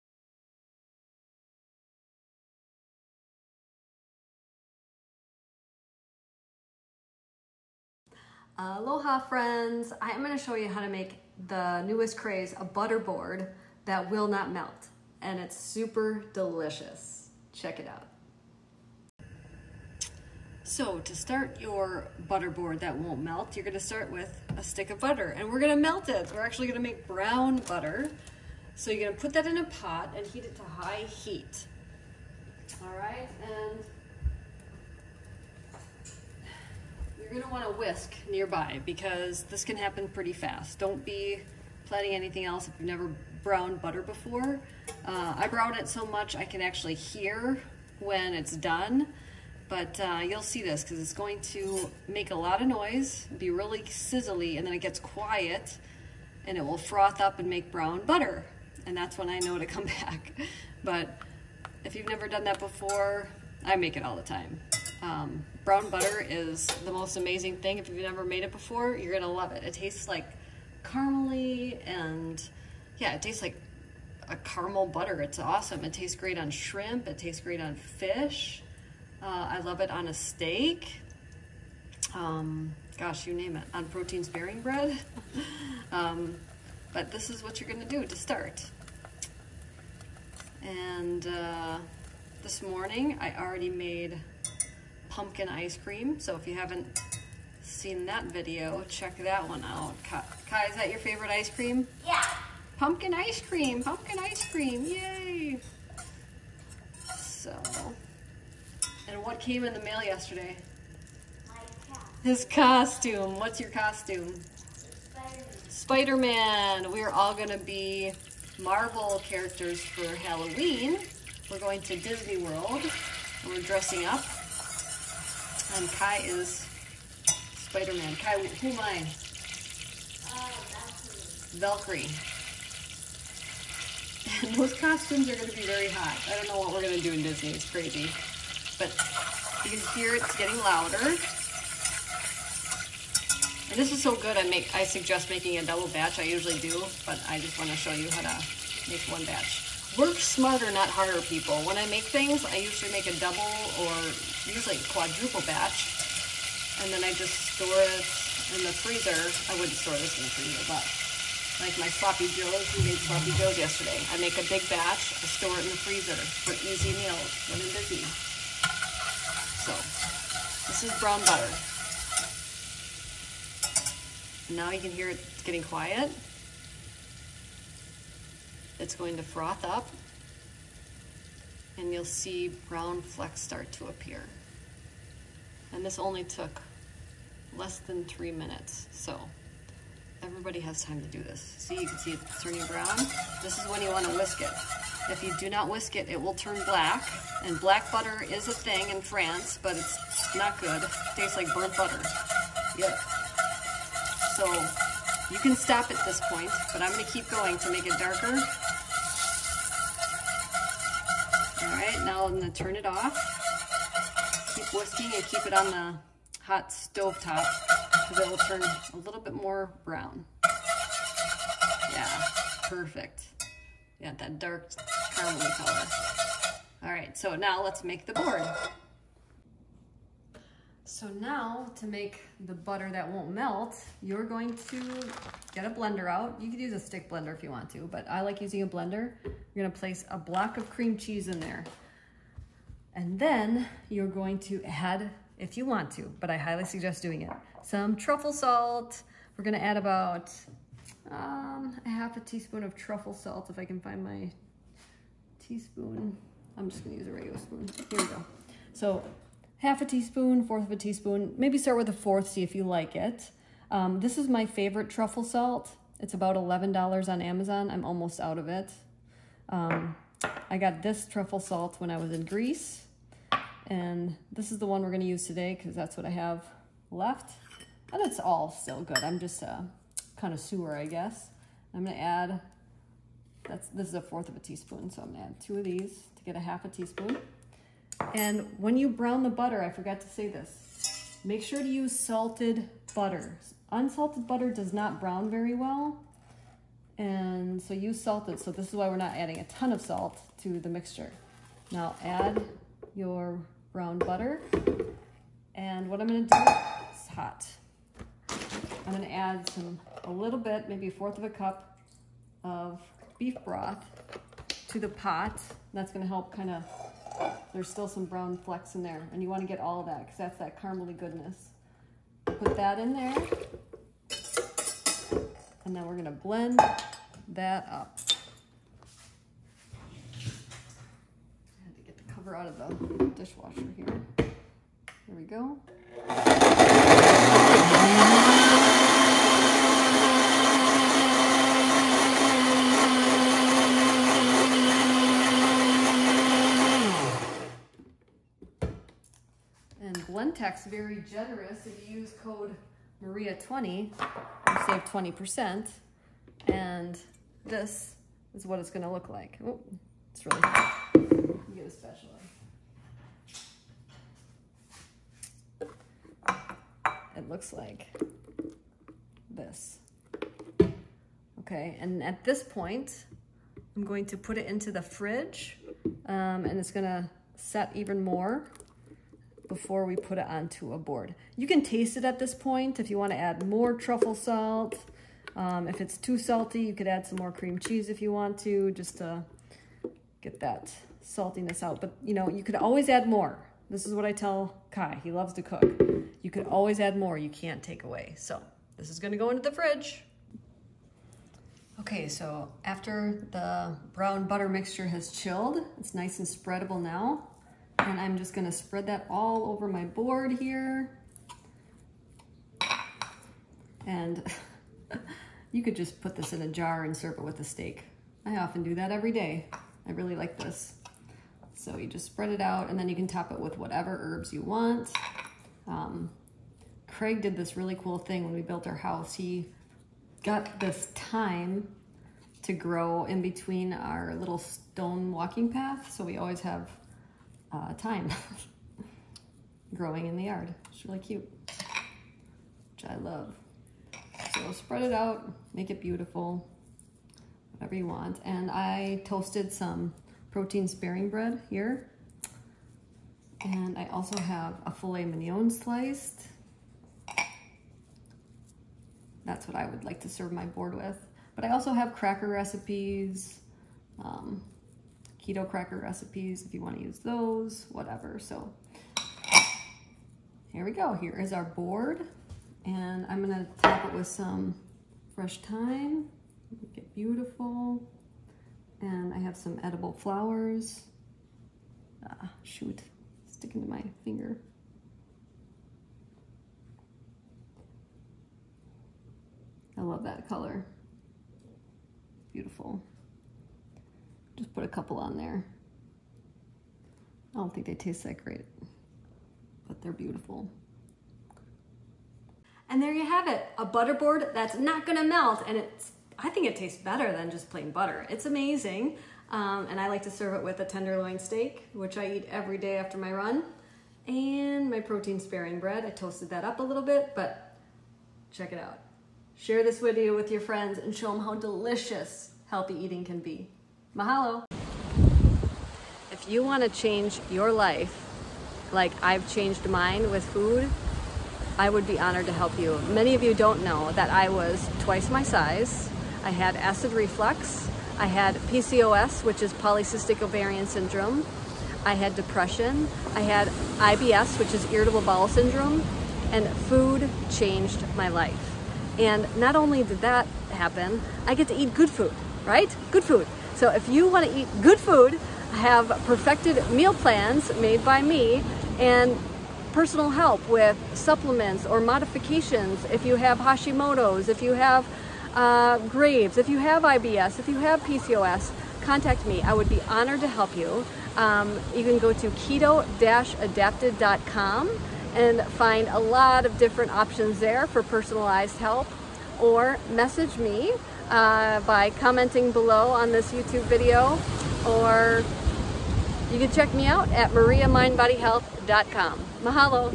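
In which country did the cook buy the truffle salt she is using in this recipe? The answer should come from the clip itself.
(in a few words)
Greece.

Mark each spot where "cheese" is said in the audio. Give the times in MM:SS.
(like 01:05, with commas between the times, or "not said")
04:00, 06:27.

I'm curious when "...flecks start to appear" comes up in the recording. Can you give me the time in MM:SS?
03:03.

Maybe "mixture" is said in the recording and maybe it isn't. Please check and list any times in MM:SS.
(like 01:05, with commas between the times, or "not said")
05:00, 06:44.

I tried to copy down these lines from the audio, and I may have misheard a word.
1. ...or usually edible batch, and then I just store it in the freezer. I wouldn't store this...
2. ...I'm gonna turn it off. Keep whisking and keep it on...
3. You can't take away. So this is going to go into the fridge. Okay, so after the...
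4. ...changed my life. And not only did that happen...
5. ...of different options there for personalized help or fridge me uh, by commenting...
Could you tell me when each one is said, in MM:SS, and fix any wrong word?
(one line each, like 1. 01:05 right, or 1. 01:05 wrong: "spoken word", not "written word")
1. 02:33 wrong: "quadruple", not "edible"
2. 03:32 right
3. 06:37 right
4. 09:07 right
5. 09:36 wrong: "message", not "fridge".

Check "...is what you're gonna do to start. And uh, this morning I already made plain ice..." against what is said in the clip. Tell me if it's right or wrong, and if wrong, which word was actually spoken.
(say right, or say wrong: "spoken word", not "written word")
wrong: "pumpkin", not "plain".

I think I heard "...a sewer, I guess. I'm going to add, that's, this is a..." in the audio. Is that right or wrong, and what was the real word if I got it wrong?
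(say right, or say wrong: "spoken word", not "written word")
right.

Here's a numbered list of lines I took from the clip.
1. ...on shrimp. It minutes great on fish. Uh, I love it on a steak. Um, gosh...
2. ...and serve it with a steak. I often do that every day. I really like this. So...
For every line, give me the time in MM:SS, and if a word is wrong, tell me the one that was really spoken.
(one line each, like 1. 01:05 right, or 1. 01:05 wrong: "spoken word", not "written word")
1. 01:16 wrong: "tastes", not "minutes"
2. 06:56 right.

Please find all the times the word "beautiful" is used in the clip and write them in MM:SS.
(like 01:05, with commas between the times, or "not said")
07:25, 07:56, 08:12, 08:19.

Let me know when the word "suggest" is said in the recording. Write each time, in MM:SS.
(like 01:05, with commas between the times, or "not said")
02:24, 04:06.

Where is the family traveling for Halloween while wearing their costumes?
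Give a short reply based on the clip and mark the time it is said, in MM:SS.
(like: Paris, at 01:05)
Disney World, at 02:01.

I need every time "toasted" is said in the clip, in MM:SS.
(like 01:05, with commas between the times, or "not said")
07:29, 08:35.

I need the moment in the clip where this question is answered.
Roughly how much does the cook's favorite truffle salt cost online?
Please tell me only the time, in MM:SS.
04:26.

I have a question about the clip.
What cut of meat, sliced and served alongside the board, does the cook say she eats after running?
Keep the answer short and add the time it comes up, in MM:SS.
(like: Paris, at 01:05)
Filet mignon, at 07:34.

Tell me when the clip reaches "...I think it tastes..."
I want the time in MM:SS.
08:26.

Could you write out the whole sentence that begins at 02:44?
I make a big batch, I store it in the freezer for easy meals when I'm busy.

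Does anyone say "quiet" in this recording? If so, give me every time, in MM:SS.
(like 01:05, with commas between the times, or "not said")
00:54, 02:55.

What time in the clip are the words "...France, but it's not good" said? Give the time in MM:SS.
03:19.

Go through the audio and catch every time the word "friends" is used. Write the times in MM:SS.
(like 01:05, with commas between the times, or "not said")
00:09, 08:40.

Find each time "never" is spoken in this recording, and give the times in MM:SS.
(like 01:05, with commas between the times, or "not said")
00:42, 01:02, 01:07.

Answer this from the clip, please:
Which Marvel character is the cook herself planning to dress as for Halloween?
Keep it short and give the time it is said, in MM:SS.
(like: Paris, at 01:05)
Valkyrie, at 02:11.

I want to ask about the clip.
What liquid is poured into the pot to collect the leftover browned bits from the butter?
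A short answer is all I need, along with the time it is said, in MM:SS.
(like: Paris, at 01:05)
Beef broth, at 05:13.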